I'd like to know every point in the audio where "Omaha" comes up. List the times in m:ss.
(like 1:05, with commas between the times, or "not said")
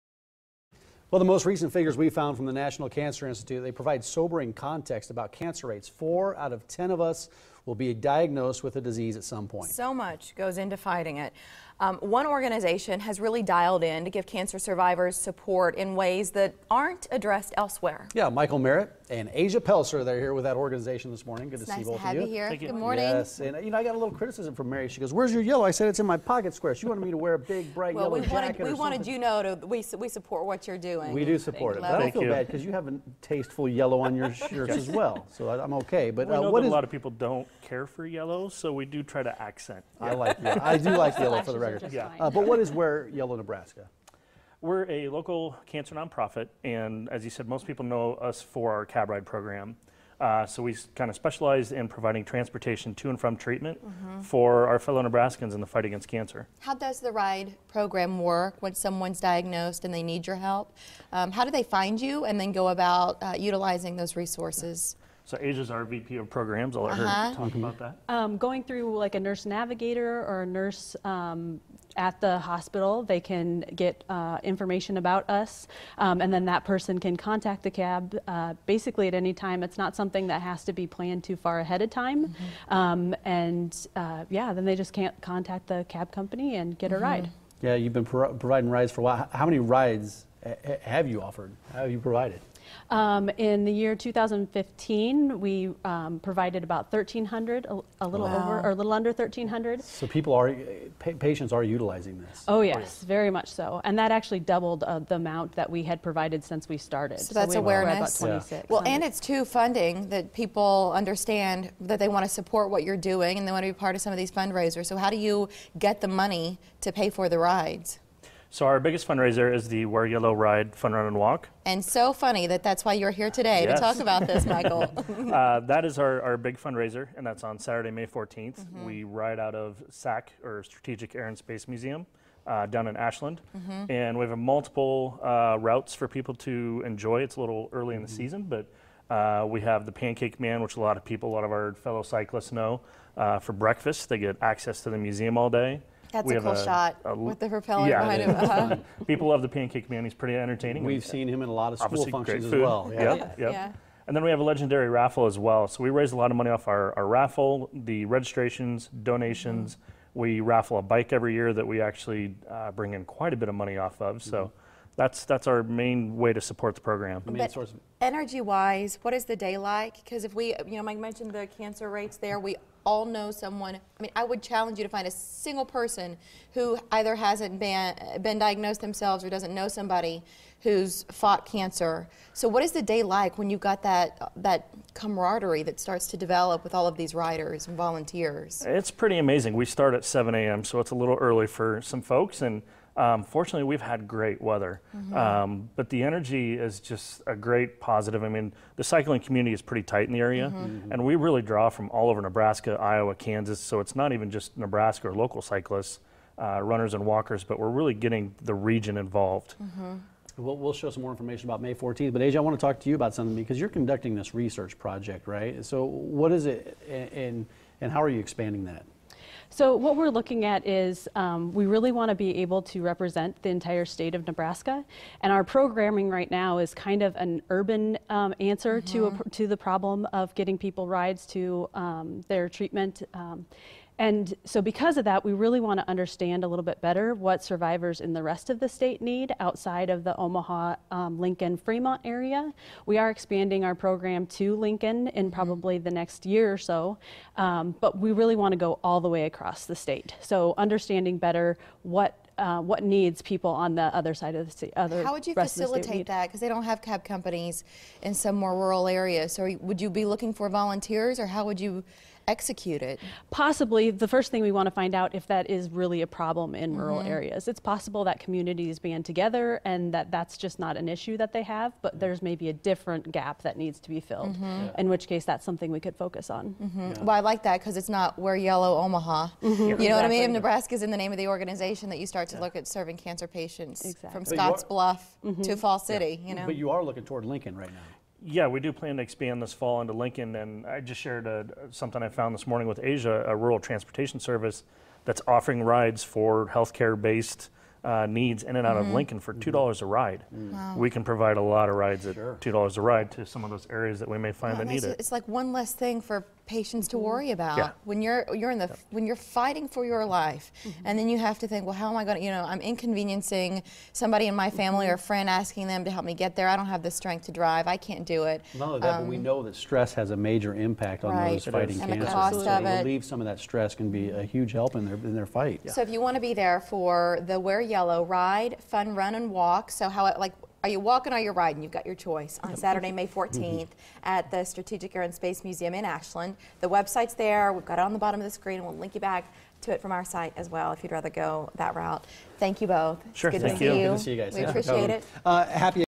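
4:00, 4:38.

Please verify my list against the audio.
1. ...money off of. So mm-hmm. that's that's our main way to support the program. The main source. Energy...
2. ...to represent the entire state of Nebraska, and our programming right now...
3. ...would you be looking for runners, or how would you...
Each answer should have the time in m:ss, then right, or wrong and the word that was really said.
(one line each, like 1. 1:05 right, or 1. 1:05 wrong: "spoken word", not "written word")
1. 2:43 right
2. 3:42 right
3. 4:19 wrong: "volunteers", not "runners".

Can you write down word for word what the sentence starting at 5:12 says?
You know, I'm inconveniencing somebody in my family or a friend, asking them to help me get there.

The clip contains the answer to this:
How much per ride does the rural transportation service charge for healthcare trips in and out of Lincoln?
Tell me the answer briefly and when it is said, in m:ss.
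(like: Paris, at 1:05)
$2, at 5:02.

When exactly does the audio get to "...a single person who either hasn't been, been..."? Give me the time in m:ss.
2:55.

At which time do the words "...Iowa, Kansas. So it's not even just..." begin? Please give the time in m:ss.
3:22.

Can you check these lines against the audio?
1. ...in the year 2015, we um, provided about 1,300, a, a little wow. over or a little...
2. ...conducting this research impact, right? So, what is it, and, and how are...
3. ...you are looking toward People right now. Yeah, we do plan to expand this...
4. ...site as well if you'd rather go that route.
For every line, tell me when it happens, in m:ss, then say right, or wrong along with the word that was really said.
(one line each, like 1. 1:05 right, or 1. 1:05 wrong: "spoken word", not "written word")
1. 1:33 right
2. 3:33 wrong: "project", not "impact"
3. 4:46 wrong: "Lincoln", not "People"
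4. 5:40 right.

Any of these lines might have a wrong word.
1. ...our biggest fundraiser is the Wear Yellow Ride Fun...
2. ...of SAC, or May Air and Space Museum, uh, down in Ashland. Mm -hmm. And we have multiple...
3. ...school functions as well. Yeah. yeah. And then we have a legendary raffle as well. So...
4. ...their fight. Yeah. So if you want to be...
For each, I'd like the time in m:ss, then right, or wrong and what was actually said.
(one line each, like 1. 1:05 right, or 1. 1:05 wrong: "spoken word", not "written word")
1. 1:58 right
2. 2:09 wrong: "Strategic", not "May"
3. 2:31 right
4. 5:25 right.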